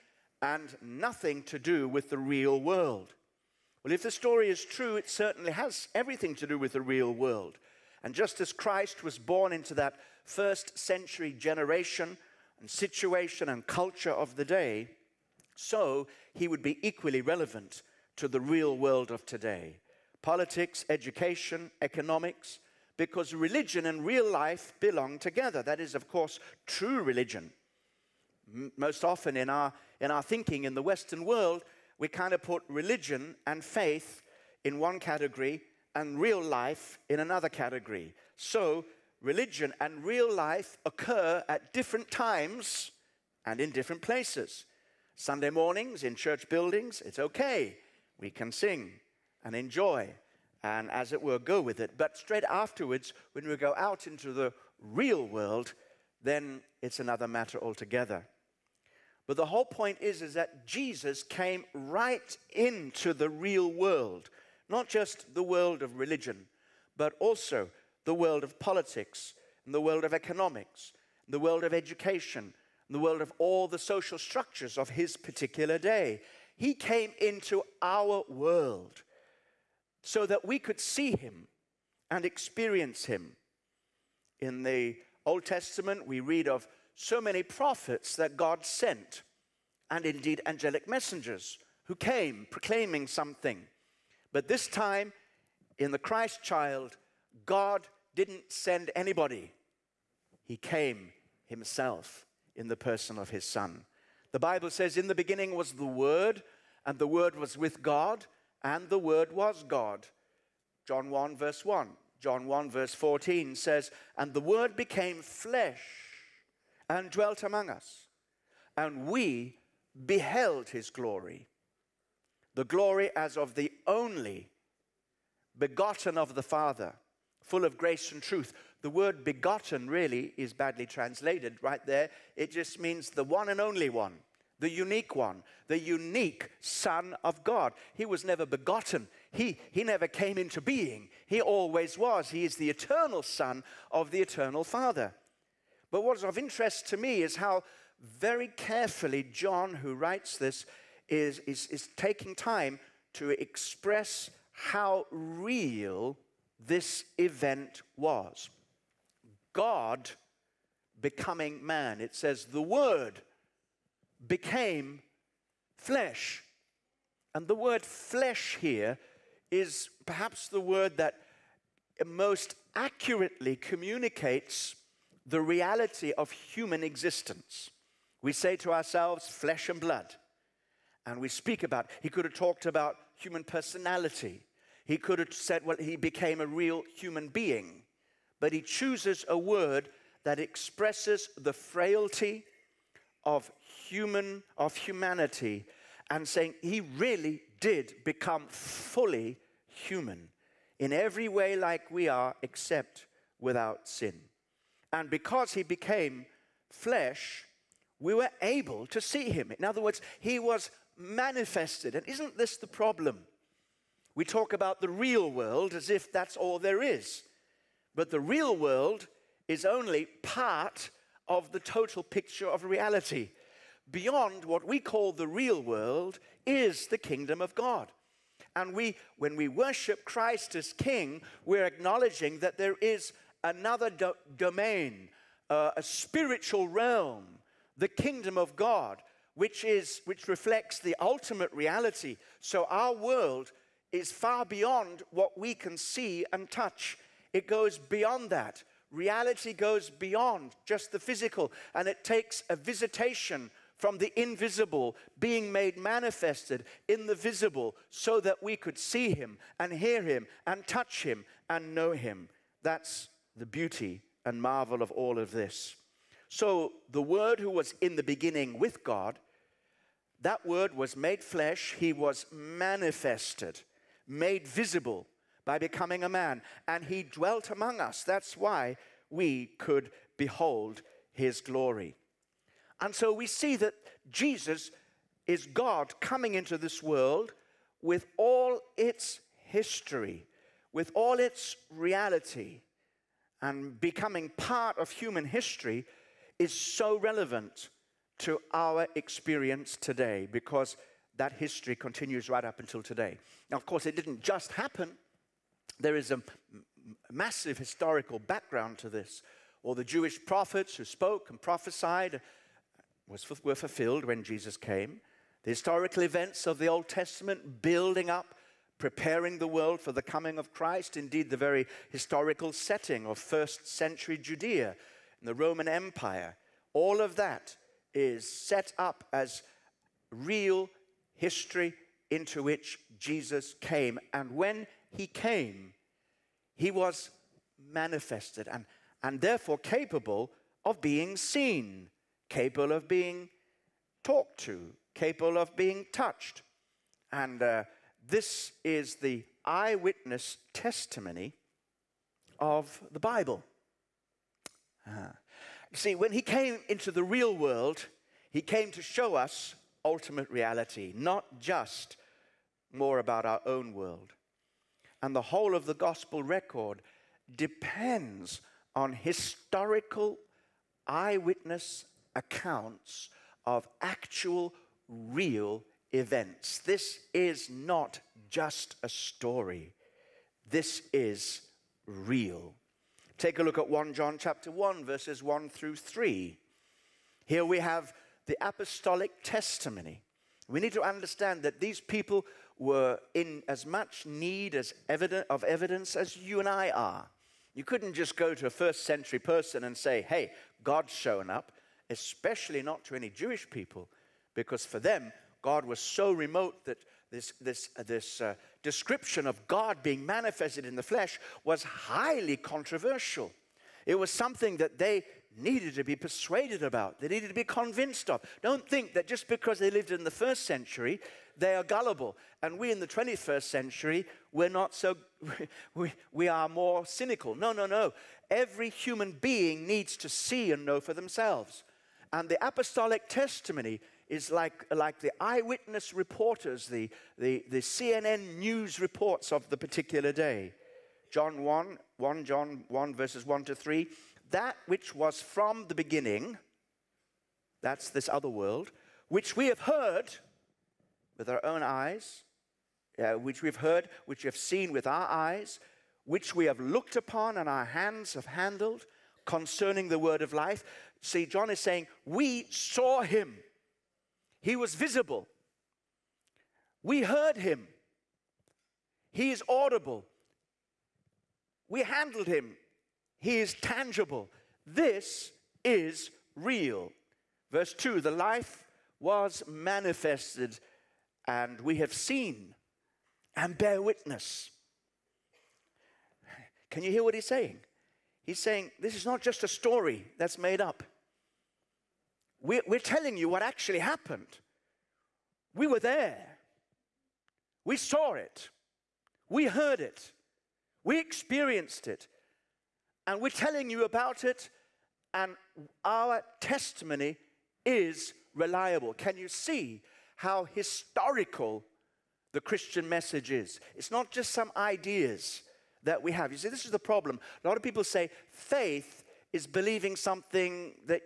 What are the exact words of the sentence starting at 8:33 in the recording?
It's not just some ideas that we have.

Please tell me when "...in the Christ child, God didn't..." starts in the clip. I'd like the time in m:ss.
1:35.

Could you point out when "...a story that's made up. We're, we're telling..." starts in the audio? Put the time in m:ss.
8:09.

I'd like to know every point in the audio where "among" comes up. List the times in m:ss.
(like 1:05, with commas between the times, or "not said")
1:57, 4:37.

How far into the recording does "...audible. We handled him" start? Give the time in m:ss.
7:49.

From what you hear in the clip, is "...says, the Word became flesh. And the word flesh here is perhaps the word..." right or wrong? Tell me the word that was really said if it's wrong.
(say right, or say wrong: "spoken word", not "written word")
right.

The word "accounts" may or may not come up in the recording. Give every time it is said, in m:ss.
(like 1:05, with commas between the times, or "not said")
6:12.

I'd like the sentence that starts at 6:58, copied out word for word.
Don't think that just because they lived in the first century, they are gullible.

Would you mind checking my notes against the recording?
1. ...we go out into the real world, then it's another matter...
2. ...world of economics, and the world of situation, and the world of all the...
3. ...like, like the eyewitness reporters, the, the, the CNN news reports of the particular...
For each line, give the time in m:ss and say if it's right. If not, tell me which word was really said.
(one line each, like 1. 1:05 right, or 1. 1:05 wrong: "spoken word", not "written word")
1. 0:53 right
2. 1:09 wrong: "education", not "situation"
3. 7:14 right.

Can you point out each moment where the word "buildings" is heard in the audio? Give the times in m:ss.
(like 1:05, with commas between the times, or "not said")
0:46, 5:17.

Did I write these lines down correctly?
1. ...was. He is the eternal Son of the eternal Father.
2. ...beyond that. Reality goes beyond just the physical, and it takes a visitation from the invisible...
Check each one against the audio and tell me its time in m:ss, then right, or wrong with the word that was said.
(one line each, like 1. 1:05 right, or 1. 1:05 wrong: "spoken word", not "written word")
1. 2:21 right
2. 4:07 right.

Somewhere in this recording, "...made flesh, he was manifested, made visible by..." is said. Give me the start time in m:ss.
4:30.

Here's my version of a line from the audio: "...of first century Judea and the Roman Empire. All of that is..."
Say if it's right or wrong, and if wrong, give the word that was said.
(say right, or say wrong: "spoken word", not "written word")
right.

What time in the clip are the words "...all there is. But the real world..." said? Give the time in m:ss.
3:36.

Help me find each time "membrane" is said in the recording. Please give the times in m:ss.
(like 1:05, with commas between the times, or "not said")
not said.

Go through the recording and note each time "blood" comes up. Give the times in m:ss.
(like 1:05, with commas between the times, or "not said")
2:59.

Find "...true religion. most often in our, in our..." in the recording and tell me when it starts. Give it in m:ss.
0:26.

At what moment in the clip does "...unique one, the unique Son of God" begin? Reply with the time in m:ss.
2:14.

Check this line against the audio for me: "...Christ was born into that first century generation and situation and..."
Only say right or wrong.
right.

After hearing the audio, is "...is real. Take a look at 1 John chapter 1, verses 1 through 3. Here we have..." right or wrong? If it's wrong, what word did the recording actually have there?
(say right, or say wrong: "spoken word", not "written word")
right.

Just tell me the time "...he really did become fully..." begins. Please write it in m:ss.
3:16.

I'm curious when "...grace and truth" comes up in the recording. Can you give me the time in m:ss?
2:07.